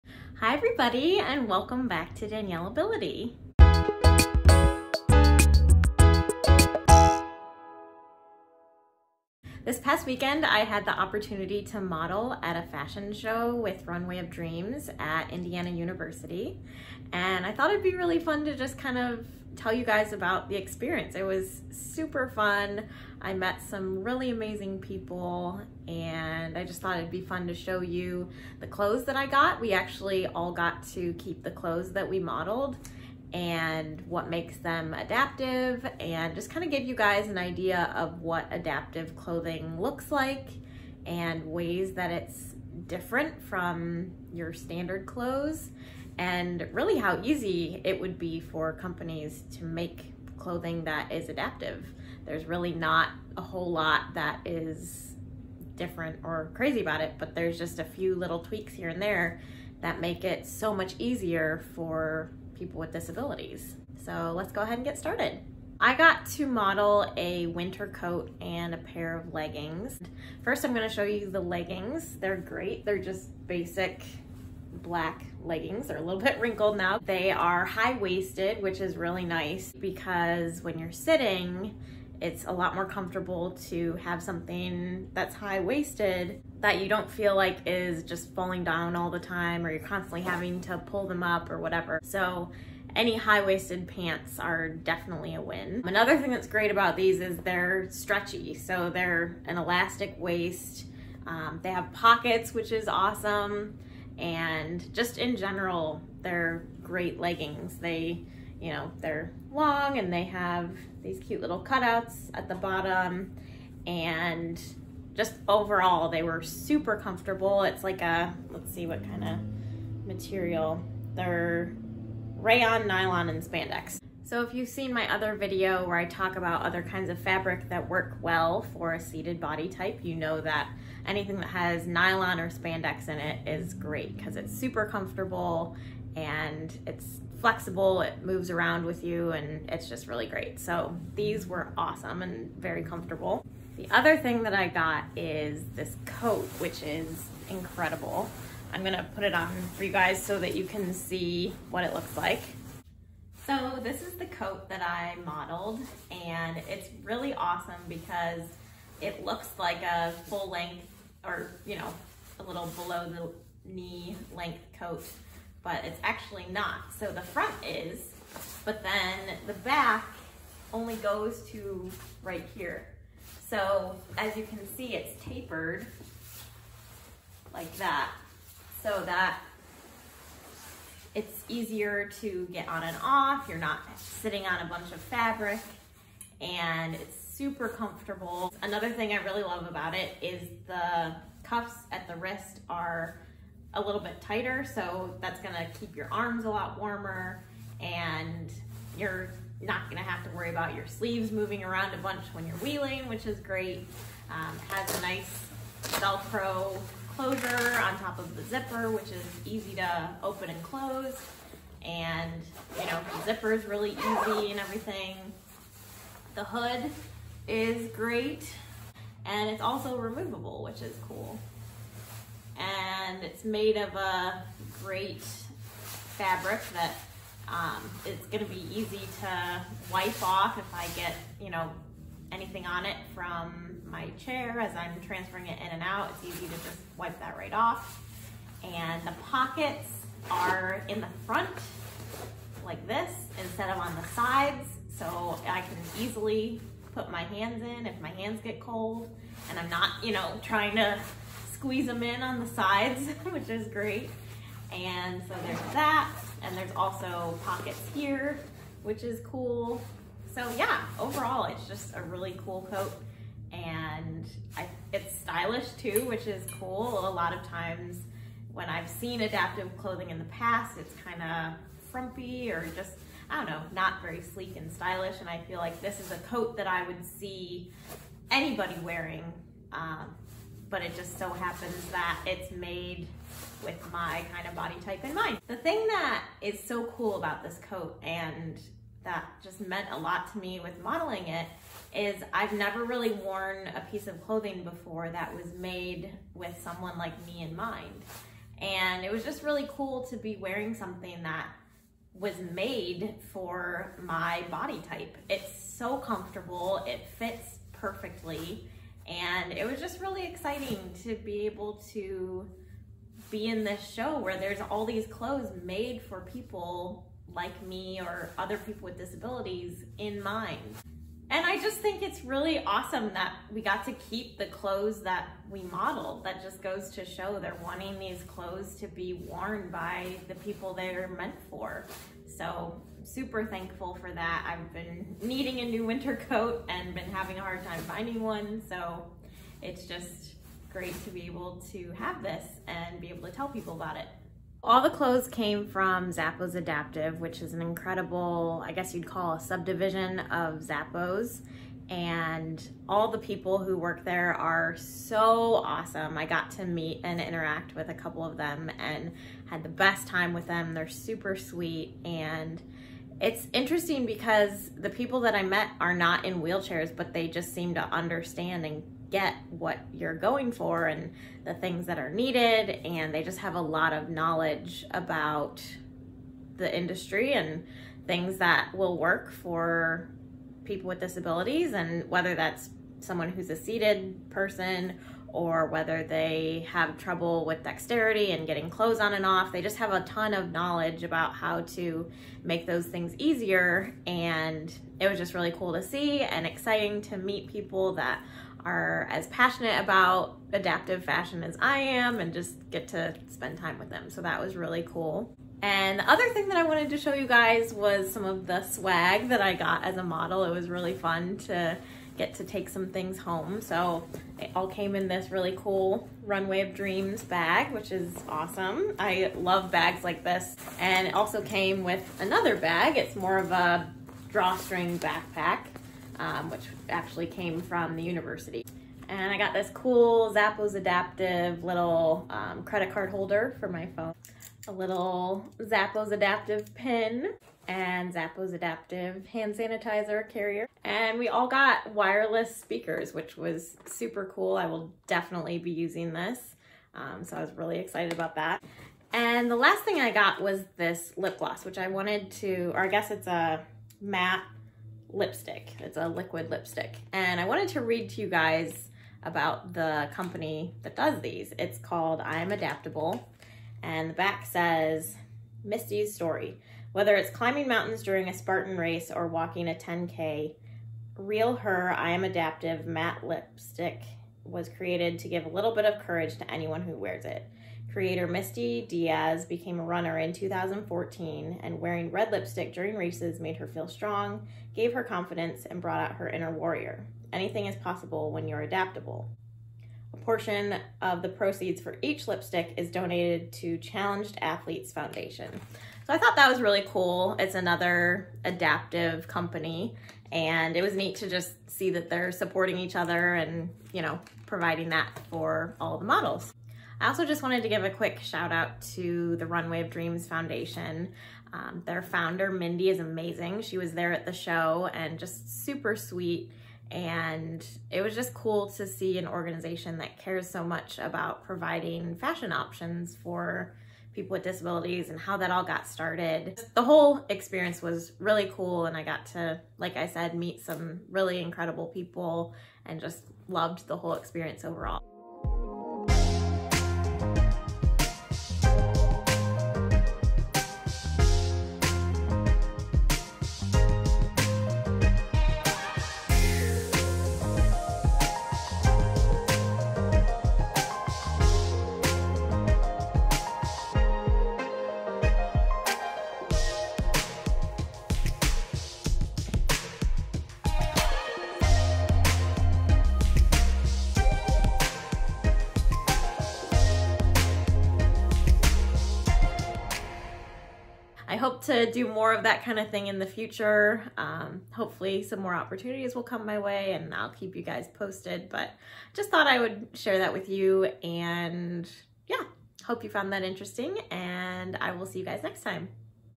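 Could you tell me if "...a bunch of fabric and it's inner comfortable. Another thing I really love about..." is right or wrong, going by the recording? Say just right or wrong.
wrong.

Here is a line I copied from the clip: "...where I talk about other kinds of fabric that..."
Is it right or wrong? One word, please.
right.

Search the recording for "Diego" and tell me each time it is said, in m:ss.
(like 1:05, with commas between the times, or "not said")
not said.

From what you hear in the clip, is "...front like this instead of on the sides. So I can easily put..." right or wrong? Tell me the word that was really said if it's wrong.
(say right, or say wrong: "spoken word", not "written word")
right.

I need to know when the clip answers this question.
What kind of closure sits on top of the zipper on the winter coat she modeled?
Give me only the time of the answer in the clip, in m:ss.
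3:25.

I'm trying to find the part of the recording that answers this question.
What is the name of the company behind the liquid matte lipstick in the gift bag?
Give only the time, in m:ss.
7:42.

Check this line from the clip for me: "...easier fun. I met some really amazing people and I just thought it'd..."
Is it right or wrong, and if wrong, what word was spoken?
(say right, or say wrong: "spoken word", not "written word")
wrong: "super", not "easier".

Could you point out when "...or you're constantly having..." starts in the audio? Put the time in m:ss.
1:29.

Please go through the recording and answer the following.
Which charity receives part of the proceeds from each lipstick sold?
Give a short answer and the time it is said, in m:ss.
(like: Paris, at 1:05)
Challenged Athletes Foundation, at 8:13.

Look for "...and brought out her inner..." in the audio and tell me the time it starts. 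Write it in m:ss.
8:05.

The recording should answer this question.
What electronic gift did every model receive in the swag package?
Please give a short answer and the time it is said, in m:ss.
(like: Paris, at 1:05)
wireless speakers, at 7:21.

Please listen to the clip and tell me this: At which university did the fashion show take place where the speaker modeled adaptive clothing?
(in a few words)
Indiana University.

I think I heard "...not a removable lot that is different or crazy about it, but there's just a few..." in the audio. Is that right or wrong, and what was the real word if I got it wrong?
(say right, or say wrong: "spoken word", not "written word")
wrong: "whole", not "removable".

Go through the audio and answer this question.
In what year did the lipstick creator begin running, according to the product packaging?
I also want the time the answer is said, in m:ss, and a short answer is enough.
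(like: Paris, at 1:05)
2014, at 8:00.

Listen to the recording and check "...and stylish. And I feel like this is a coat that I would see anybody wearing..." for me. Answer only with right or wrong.
right.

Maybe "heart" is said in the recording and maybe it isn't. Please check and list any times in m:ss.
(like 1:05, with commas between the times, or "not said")
not said.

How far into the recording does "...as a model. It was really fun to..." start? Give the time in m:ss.
6:49.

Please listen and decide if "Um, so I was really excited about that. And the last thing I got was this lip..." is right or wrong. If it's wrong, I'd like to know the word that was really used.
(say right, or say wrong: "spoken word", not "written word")
right.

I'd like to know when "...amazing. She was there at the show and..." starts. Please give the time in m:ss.
8:32.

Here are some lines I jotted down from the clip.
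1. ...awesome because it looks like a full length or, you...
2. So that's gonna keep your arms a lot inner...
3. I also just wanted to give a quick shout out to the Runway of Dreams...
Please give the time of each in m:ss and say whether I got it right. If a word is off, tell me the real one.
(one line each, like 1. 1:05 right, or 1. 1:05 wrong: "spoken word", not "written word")
1. 2:37 right
2. 3:14 wrong: "warmer", not "inner"
3. 8:27 right.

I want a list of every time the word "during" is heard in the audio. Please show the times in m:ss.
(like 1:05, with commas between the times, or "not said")
7:48, 8:02.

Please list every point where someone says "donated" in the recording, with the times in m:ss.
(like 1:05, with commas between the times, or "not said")
8:12.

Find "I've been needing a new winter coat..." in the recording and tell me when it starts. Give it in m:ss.
5:34.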